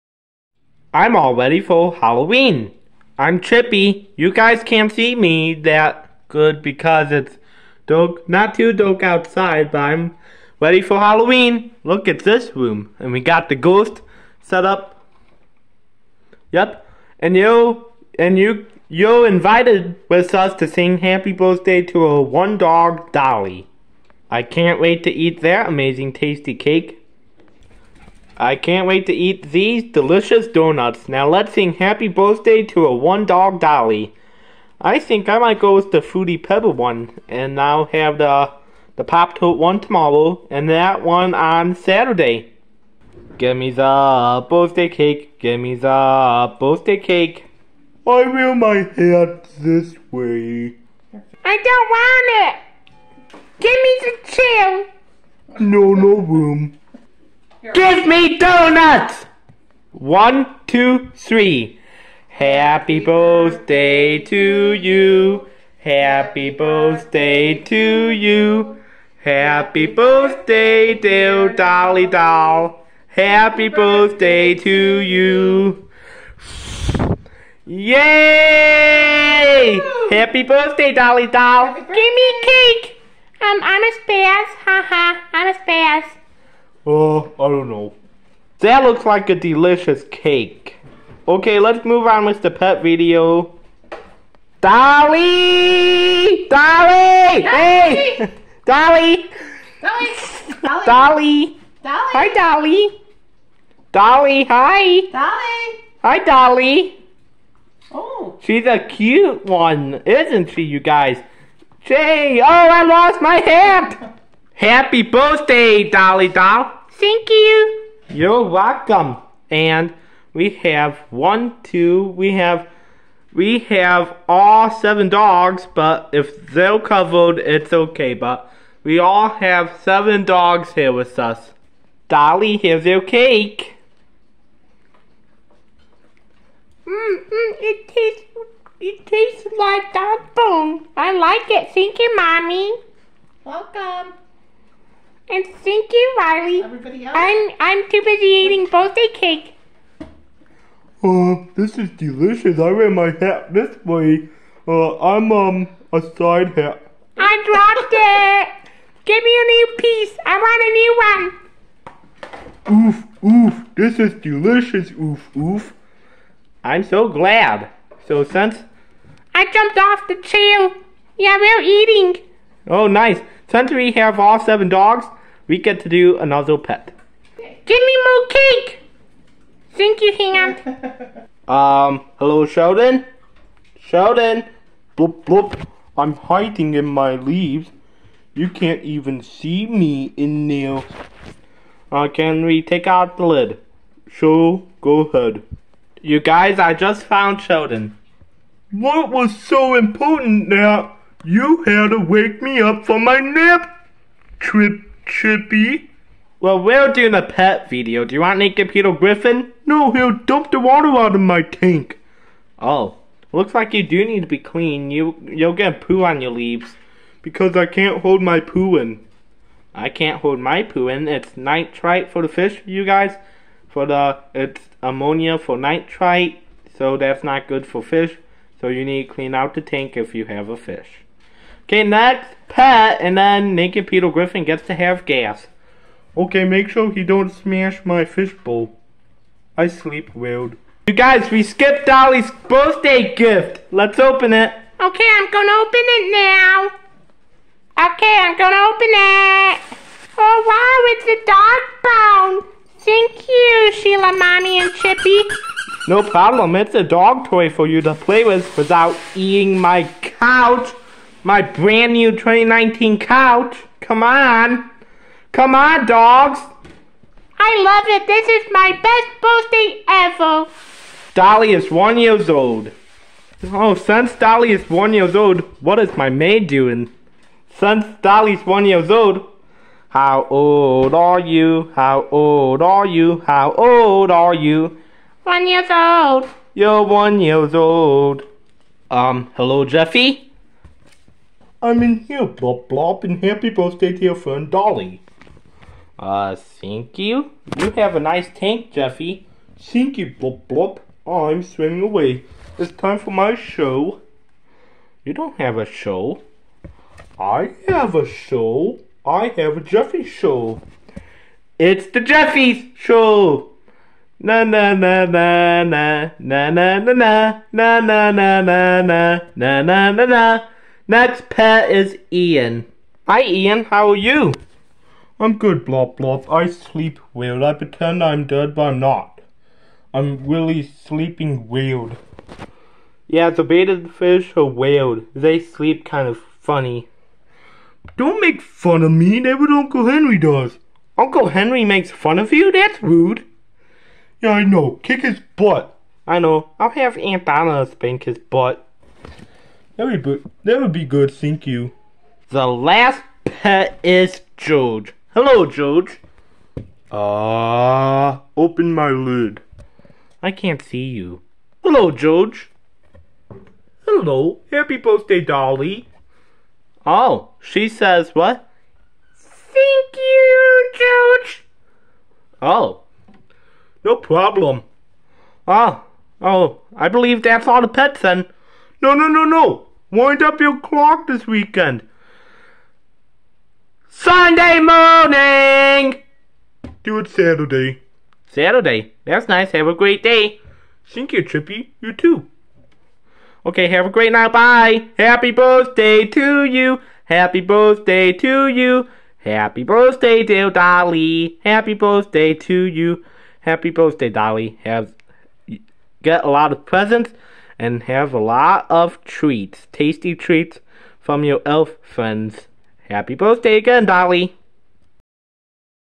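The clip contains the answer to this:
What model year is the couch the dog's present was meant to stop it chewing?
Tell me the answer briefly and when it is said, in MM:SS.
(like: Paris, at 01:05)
2019, at 04:22.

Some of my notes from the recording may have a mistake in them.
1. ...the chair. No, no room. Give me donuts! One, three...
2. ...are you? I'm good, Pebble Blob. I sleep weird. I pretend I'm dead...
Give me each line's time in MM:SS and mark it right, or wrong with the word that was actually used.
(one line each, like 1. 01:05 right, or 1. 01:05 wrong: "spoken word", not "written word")
1. 00:54 wrong: "two", not "three"
2. 05:23 wrong: "Blob", not "Pebble".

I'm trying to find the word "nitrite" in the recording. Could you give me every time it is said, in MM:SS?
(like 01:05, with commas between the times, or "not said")
03:41, 03:45.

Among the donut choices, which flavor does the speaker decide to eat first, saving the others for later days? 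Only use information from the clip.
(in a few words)
Fruity Pebble.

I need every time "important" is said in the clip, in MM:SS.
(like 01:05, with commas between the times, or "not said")
03:19.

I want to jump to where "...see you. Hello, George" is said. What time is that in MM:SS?
06:00.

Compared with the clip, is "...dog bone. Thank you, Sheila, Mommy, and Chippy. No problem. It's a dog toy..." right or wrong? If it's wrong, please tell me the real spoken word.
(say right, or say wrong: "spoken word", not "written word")
right.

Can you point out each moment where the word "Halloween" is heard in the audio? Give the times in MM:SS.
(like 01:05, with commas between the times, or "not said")
00:01, 00:10.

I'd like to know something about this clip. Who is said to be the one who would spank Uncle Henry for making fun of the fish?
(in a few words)
Aunt Donna.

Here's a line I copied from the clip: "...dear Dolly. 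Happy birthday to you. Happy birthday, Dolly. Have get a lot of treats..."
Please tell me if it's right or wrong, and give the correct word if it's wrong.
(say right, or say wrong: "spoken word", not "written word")
wrong: "presents", not "treats".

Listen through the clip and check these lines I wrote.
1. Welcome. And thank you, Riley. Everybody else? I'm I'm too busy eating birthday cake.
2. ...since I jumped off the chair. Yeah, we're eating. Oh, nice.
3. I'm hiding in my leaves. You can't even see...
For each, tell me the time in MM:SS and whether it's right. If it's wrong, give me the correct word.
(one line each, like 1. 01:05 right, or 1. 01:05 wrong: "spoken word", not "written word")
1. 02:23 right
2. 02:48 right
3. 03:05 right.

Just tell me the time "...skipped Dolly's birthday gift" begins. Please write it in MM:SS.
04:01.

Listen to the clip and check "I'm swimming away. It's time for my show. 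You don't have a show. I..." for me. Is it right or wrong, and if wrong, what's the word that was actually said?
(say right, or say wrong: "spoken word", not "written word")
right.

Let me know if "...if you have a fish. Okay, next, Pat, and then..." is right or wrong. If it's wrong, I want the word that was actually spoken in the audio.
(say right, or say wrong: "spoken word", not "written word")
right.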